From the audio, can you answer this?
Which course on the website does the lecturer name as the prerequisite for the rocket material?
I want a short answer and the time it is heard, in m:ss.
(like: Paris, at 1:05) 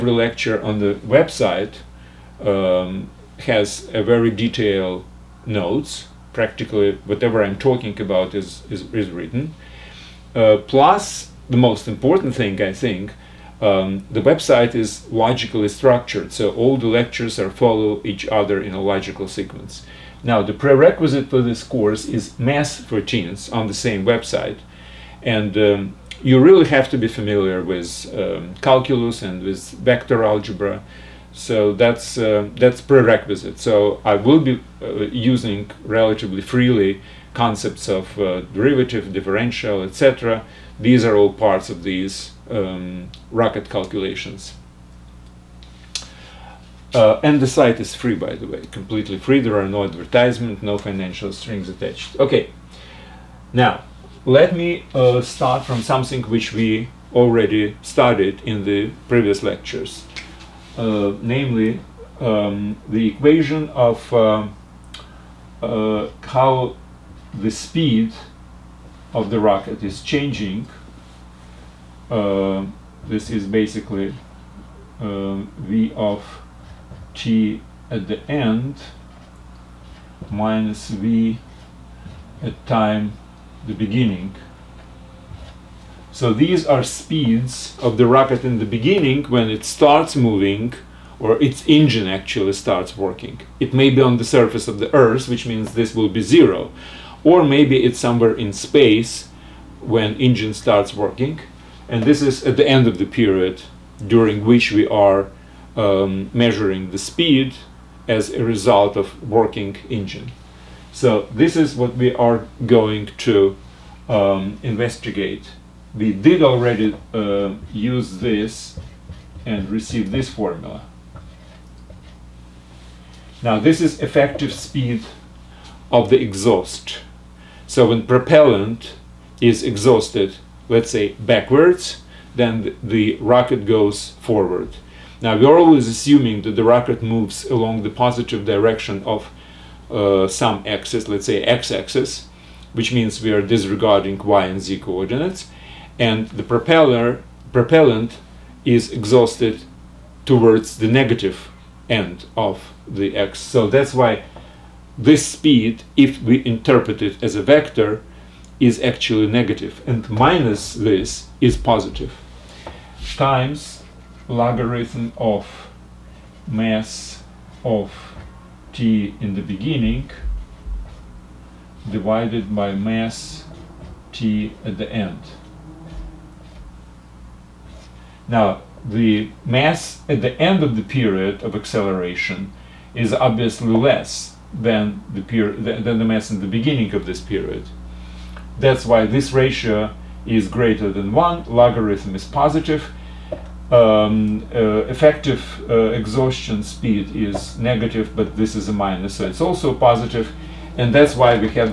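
Math for Teens, at 0:22.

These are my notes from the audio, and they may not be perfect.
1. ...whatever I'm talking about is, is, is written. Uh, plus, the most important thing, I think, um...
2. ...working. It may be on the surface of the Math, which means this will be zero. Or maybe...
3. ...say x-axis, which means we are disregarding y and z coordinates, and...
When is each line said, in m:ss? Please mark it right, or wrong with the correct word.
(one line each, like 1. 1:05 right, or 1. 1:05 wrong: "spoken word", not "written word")
1. 0:07 right
2. 1:32 wrong: "Earth", not "Math"
3. 2:21 right.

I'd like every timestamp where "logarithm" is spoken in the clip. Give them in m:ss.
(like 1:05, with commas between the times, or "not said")
2:44, 3:11.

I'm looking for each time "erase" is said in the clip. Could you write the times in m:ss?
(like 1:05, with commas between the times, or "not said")
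not said.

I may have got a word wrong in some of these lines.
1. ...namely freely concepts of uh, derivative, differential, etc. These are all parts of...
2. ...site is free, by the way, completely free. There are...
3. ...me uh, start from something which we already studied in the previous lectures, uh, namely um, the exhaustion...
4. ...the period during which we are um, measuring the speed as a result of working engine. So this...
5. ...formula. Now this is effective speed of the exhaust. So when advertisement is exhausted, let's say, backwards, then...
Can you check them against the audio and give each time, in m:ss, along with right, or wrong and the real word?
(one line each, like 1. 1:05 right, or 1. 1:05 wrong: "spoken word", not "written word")
1. 0:35 wrong: "relatively", not "namely"
2. 0:47 right
3. 0:54 wrong: "equation", not "exhaustion"
4. 1:42 right
5. 2:00 wrong: "propellant", not "advertisement".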